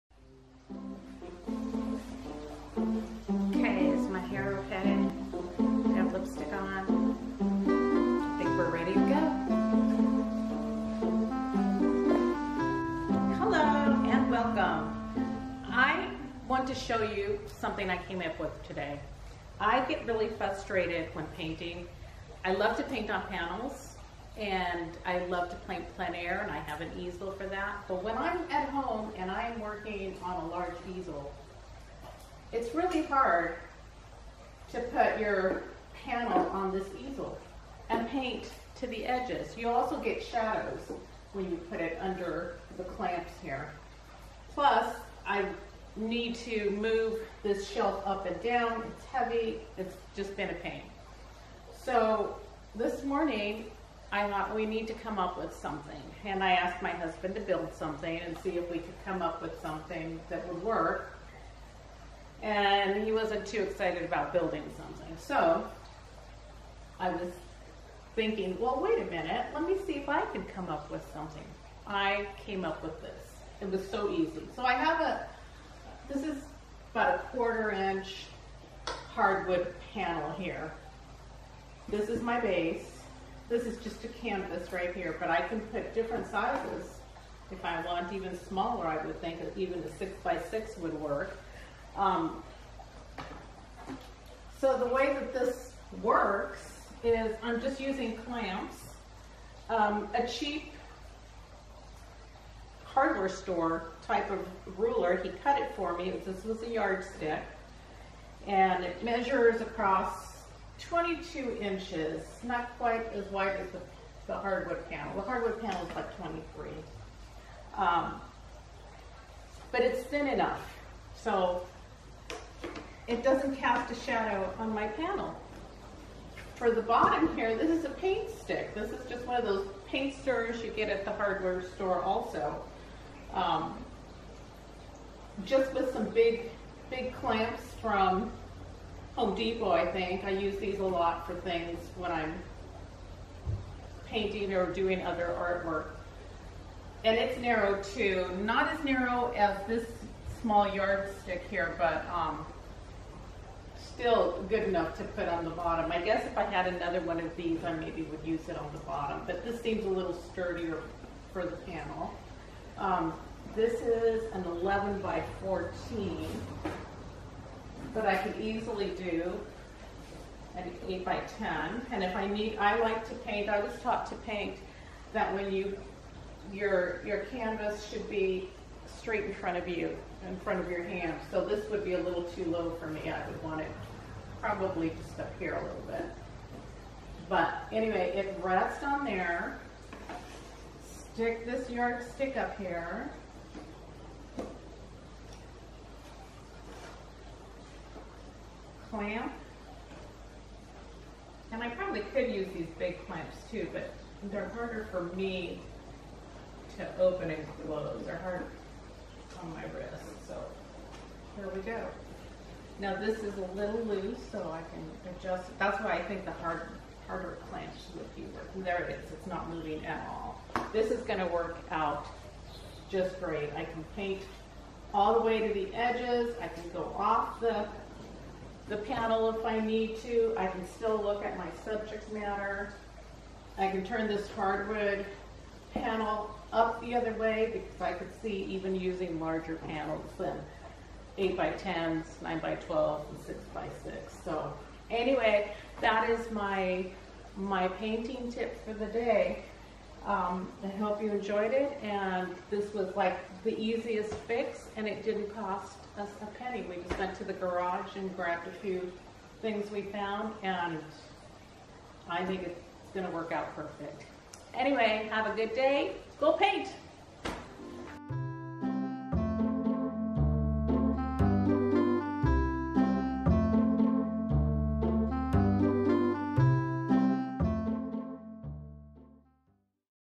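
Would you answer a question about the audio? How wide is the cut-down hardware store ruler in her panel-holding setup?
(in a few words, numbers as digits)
22 inches.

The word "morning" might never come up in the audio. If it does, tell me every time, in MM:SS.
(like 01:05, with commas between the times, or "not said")
00:53.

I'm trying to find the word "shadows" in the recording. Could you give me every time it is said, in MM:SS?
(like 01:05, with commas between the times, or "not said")
00:40, 02:04.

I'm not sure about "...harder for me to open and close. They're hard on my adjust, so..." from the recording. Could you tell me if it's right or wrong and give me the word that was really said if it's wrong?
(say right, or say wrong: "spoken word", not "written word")
wrong: "wrist", not "adjust".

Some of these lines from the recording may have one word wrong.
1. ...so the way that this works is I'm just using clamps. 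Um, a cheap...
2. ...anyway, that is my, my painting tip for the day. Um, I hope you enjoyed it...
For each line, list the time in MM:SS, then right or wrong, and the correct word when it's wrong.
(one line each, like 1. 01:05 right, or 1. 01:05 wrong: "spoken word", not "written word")
1. 01:34 right
2. 04:04 right.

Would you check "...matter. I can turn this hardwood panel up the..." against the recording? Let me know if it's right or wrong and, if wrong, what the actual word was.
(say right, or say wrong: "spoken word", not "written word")
right.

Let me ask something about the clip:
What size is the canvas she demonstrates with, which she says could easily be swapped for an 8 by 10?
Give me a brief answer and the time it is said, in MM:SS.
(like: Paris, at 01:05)
11 by 14, at 02:44.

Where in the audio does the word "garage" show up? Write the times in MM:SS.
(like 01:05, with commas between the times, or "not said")
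04:17.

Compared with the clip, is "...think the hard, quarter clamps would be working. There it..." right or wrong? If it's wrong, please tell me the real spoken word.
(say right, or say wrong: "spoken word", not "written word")
wrong: "harder", not "quarter".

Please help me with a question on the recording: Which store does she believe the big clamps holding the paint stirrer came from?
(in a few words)
Home Depot.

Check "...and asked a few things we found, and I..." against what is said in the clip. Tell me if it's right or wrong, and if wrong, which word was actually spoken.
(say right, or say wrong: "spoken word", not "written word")
wrong: "grabbed", not "asked".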